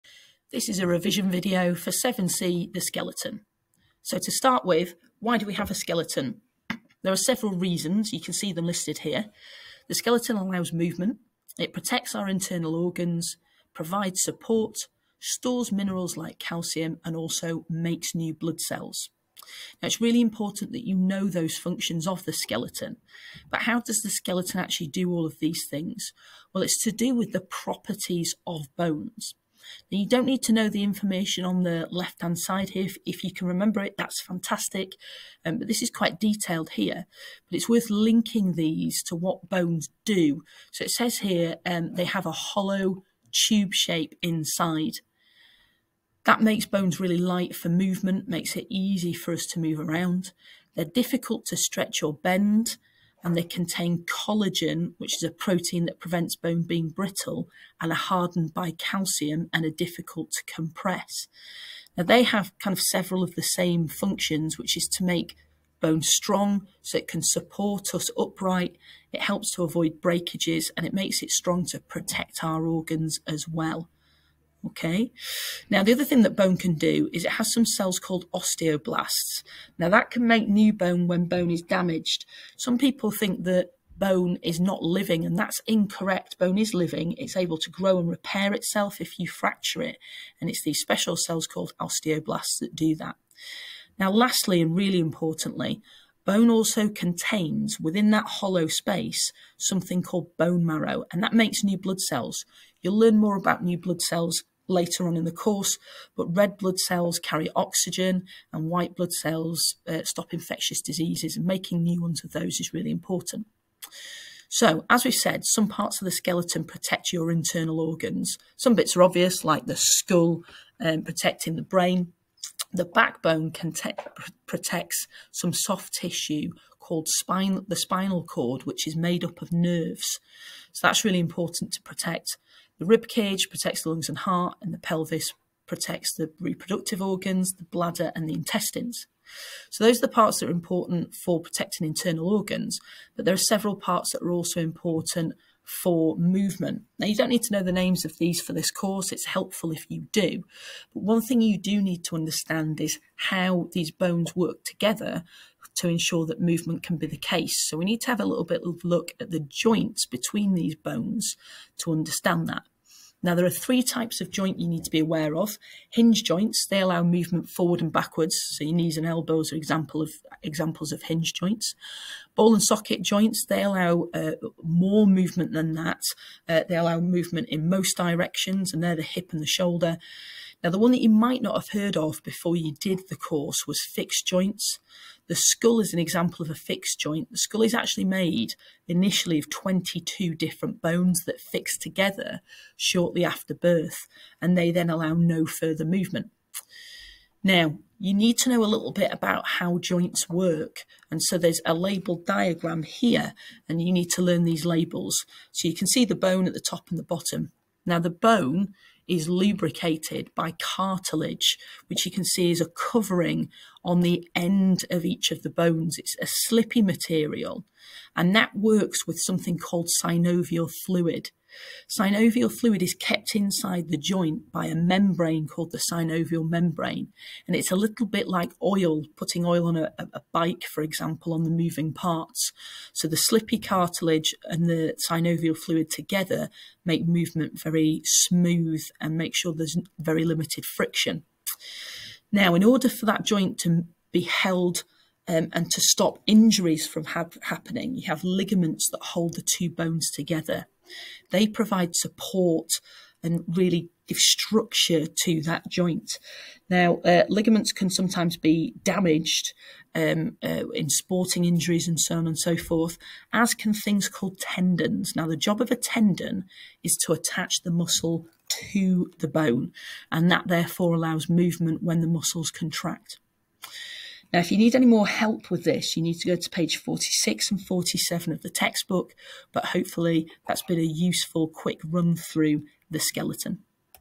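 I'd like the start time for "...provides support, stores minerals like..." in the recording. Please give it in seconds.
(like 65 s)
13 s.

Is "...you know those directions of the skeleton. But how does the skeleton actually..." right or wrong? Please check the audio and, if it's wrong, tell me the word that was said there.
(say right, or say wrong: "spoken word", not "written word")
wrong: "functions", not "directions".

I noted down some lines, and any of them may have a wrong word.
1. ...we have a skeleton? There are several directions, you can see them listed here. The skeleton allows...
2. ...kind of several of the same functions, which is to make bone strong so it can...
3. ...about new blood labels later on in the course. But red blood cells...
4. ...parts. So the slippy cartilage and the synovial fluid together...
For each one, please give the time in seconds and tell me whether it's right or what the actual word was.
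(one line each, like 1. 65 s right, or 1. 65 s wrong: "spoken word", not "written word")
1. 5 s wrong: "reasons", not "directions"
2. 62 s right
3. 103 s wrong: "cells", not "labels"
4. 231 s right.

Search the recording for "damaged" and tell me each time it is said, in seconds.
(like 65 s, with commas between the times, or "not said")
81 s, 258 s.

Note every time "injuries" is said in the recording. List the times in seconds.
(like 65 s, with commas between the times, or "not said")
246 s, 261 s.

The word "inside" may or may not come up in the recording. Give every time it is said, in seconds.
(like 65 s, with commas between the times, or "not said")
44 s, 223 s.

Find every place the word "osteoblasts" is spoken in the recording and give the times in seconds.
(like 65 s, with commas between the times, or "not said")
78 s, 91 s.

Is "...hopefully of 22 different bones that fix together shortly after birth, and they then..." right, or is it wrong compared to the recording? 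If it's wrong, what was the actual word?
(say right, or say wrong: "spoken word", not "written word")
wrong: "initially", not "hopefully".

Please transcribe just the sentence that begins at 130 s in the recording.
So that's really important to protect.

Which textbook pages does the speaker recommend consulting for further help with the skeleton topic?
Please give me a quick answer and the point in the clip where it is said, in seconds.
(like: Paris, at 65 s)
46 and 47, at 276 s.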